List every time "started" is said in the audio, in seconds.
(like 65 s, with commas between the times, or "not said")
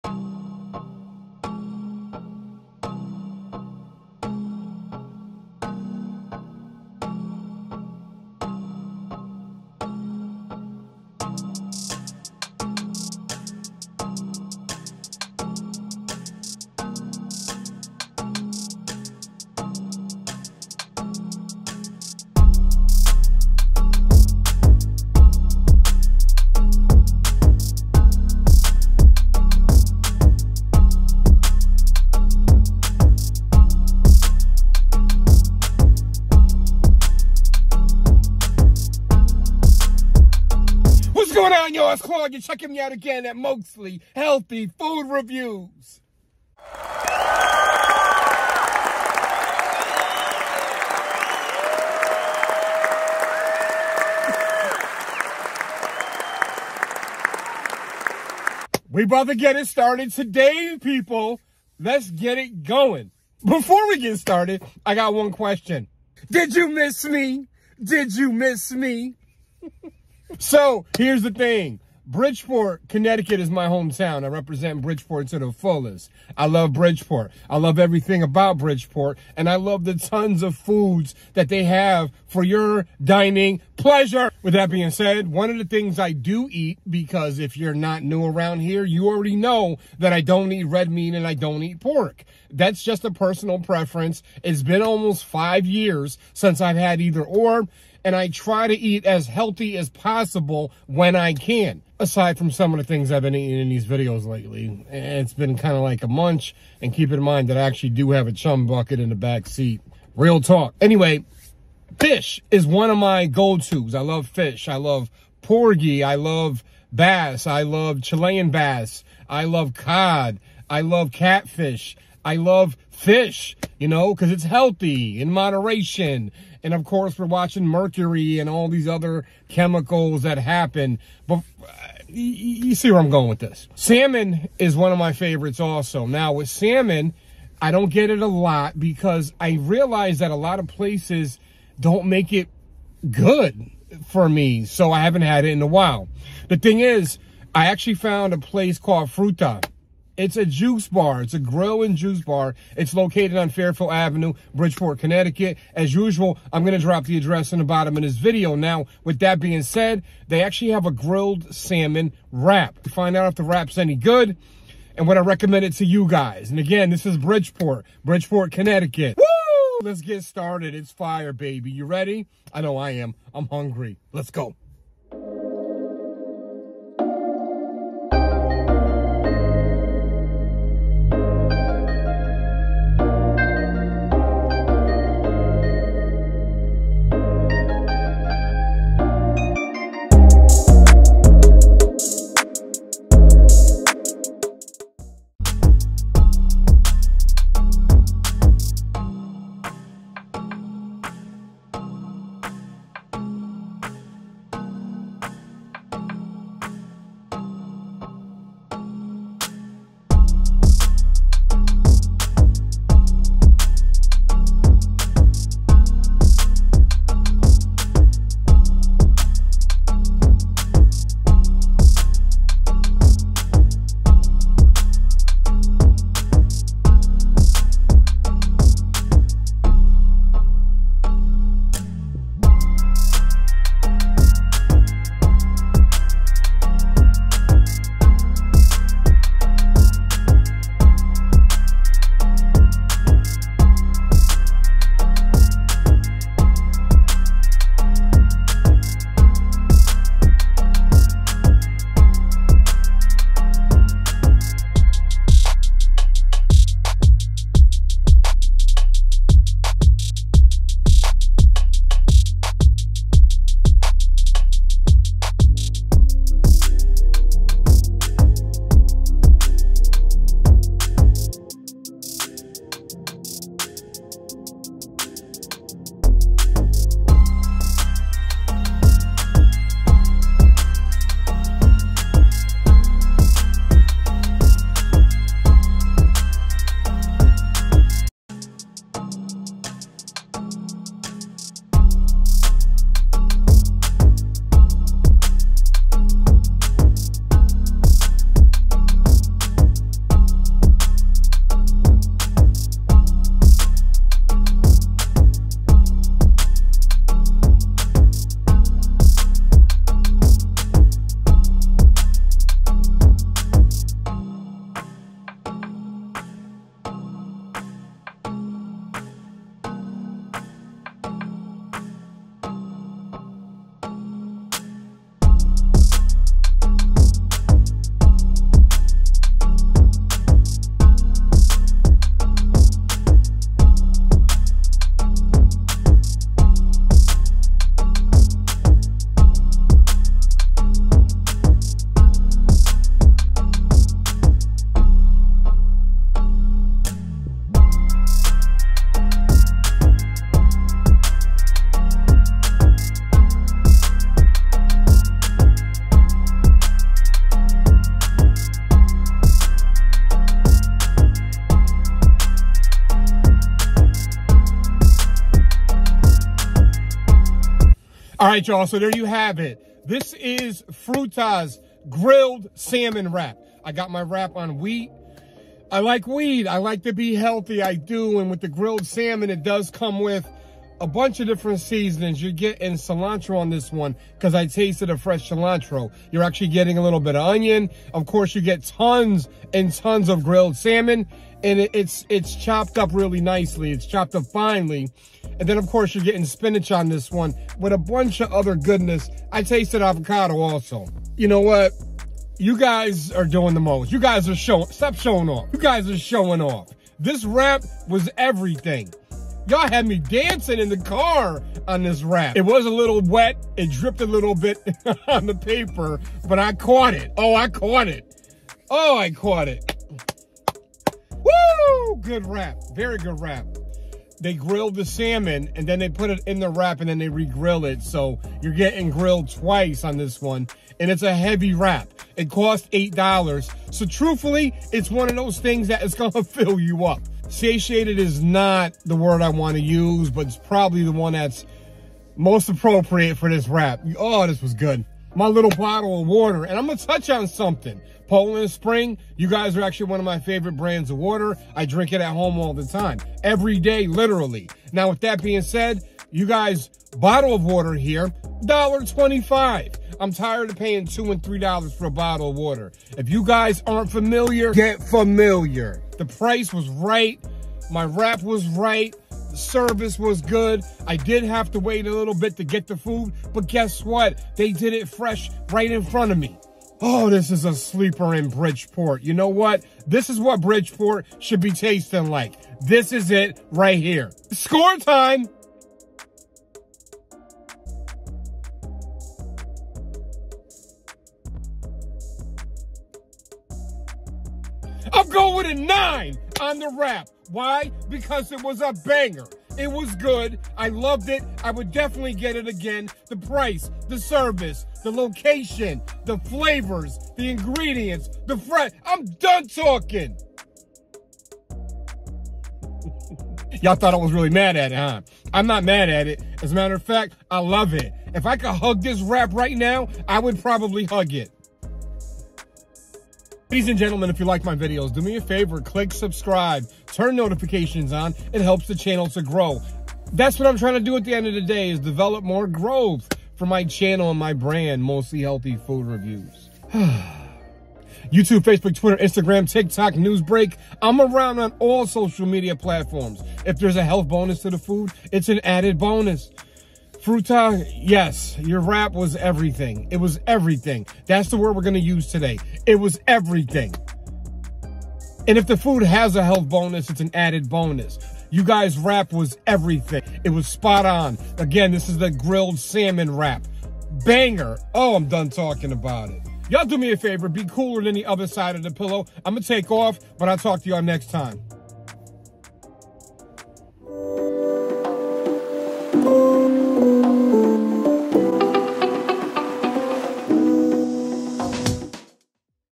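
59 s, 64 s, 170 s.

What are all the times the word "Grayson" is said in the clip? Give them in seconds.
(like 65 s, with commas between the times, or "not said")
not said.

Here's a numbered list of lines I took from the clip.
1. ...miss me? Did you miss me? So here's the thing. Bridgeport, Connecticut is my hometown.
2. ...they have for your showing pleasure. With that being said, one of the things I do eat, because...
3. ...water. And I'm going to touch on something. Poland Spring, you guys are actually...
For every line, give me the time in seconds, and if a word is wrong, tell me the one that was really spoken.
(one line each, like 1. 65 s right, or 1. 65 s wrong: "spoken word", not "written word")
1. 66 s right
2. 81 s wrong: "dining", not "showing"
3. 446 s right.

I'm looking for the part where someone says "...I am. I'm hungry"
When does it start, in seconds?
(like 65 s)
172 s.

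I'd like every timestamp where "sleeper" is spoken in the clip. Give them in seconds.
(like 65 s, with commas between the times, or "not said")
477 s.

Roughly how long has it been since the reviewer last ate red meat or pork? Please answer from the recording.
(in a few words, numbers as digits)
almost 5 years.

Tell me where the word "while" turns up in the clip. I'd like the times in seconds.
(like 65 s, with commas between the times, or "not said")
145 s.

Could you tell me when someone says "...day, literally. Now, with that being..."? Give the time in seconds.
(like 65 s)
453 s.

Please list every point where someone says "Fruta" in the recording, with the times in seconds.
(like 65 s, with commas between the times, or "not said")
149 s, 370 s, 547 s.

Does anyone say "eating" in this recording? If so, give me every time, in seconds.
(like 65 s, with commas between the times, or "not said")
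103 s.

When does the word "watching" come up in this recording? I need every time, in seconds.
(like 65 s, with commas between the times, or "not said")
127 s.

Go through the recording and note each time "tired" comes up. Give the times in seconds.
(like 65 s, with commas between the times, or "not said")
460 s.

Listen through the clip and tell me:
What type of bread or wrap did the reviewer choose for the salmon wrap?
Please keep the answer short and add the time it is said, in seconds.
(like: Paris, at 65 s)
wheat, at 374 s.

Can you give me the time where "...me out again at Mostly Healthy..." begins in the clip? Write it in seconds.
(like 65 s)
42 s.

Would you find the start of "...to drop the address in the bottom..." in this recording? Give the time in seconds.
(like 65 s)
156 s.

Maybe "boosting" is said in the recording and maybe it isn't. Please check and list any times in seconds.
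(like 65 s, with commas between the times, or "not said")
not said.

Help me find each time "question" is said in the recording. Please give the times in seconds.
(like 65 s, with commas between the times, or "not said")
65 s.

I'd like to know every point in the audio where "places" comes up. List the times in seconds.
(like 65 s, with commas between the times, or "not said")
140 s, 148 s.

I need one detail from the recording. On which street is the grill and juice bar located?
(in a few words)
Fairfield Avenue.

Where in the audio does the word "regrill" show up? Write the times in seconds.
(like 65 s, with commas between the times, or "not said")
427 s.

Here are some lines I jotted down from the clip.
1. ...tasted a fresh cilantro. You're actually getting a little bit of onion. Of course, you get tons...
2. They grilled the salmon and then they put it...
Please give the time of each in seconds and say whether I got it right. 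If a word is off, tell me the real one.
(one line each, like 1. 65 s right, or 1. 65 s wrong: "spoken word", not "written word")
1. 384 s right
2. 424 s right.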